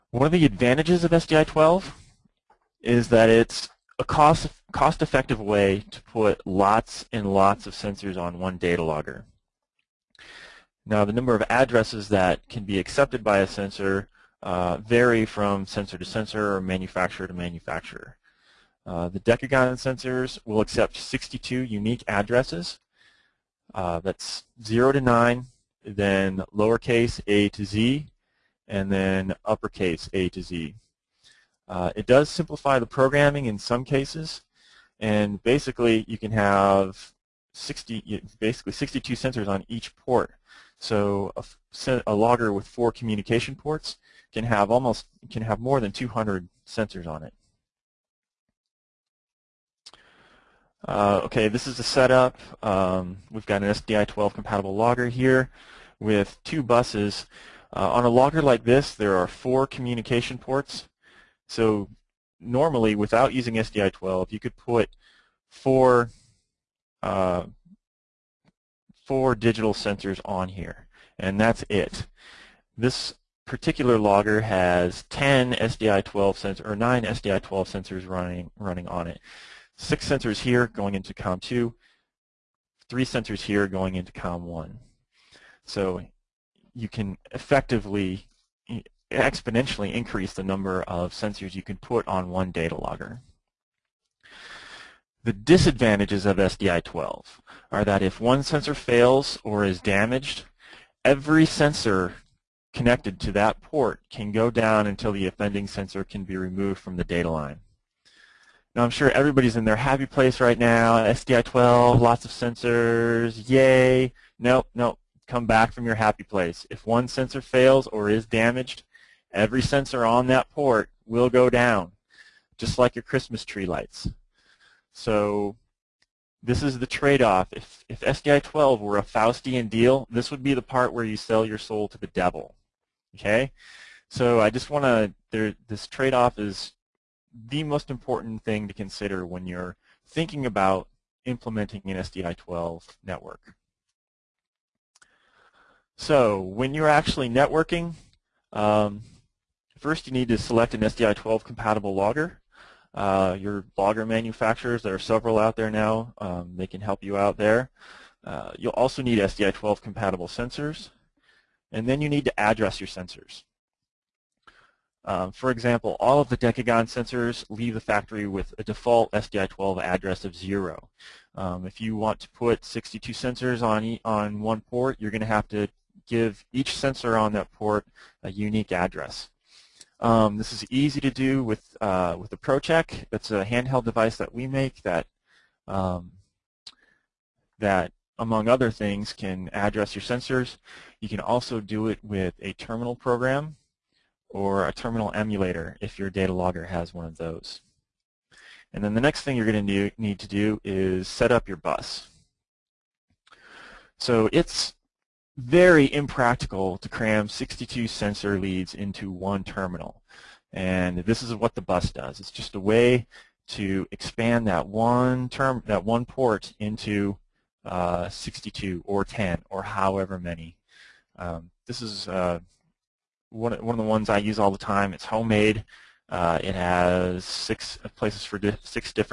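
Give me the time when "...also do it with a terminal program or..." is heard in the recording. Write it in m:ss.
3:11.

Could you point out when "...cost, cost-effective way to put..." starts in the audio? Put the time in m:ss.
0:04.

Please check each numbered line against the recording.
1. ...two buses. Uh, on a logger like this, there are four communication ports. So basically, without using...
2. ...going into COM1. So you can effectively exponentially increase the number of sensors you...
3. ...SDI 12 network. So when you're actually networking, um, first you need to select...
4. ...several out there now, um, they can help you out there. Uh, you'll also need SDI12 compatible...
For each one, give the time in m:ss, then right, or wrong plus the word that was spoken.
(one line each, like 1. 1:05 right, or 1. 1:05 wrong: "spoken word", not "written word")
1. 0:56 wrong: "normally", not "basically"
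2. 1:23 right
3. 2:21 right
4. 2:34 right.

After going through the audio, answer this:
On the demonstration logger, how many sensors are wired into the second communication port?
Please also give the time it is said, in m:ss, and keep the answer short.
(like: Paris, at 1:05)
6, at 1:19.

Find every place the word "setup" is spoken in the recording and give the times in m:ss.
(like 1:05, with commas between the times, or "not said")
0:51.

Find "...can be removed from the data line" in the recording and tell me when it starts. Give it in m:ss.
1:46.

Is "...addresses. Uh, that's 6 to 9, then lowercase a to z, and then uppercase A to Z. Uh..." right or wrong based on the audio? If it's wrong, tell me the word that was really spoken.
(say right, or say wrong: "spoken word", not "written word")
wrong: "0", not "6".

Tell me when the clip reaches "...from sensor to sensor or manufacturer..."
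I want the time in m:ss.
0:15.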